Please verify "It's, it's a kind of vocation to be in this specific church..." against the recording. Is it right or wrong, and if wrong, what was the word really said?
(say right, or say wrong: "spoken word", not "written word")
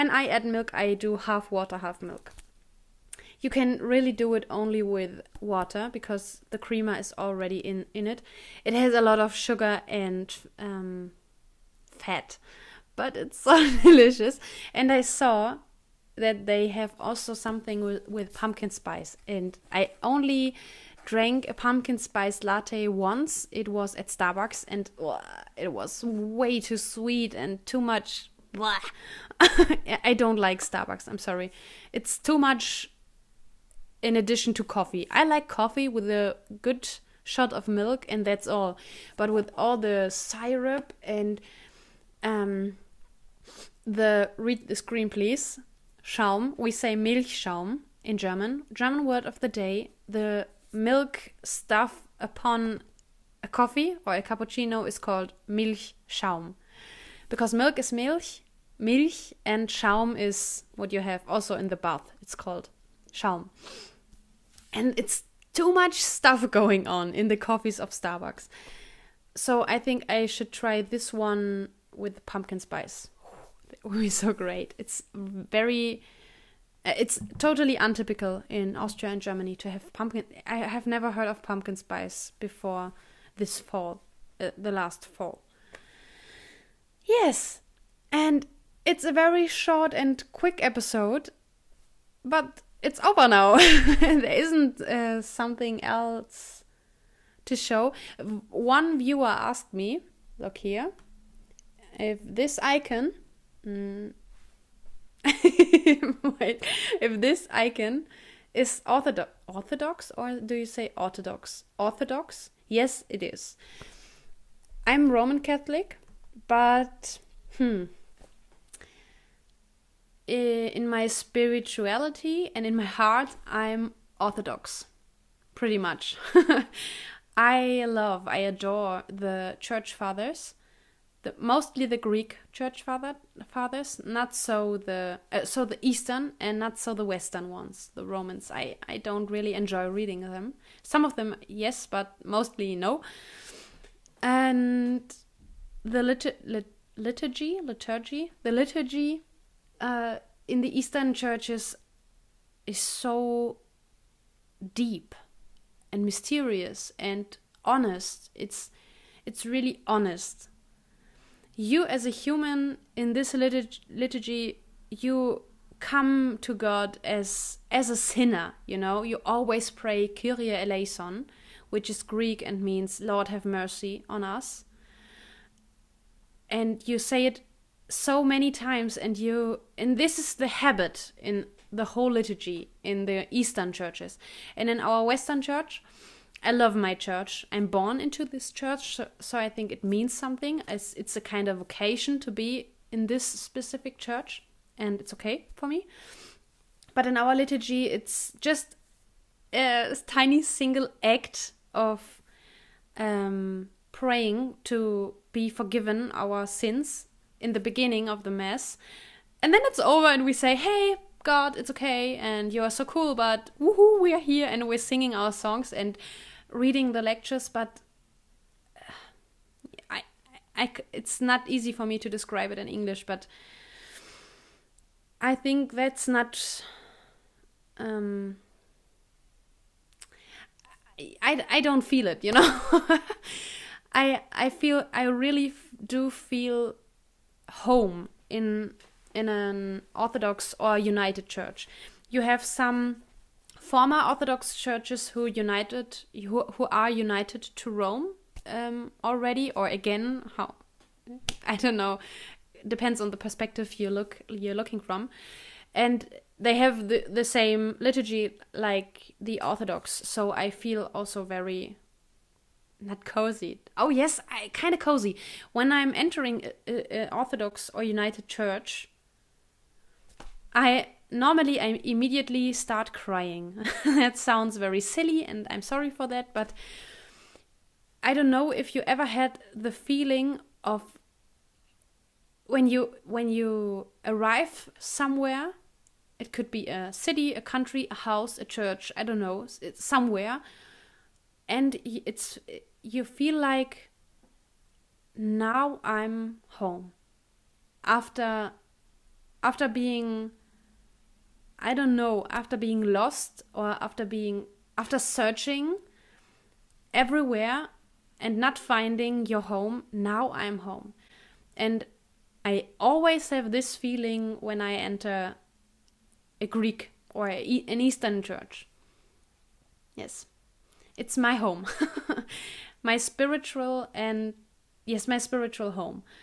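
right.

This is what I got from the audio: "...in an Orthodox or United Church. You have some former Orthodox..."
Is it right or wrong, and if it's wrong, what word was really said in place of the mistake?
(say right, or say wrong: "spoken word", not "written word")
right.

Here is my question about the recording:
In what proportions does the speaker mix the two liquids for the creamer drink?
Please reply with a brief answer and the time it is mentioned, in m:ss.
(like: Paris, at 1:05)
half water, half milk, at 0:01.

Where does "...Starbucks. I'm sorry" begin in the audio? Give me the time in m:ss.
0:30.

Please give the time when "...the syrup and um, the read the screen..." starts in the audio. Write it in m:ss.
0:39.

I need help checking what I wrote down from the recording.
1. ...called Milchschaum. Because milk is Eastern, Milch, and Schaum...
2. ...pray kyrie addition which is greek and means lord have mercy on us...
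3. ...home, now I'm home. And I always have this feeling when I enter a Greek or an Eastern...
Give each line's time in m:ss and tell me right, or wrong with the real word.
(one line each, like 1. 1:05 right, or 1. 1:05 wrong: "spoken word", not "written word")
1. 0:54 wrong: "Milch", not "Eastern"
2. 2:49 wrong: "eleison", not "addition"
3. 5:09 right.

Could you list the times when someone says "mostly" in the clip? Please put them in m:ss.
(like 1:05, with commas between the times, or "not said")
2:11, 2:22.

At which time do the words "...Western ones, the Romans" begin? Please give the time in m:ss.
2:17.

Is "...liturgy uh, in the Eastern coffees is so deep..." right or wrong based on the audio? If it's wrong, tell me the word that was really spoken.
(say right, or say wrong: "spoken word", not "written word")
wrong: "churches", not "coffees".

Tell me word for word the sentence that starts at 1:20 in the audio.
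I have never heard of pumpkin spice before this fall, uh, the last fall.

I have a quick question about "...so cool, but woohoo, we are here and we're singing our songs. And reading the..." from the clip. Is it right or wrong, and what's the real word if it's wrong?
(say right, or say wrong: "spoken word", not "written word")
right.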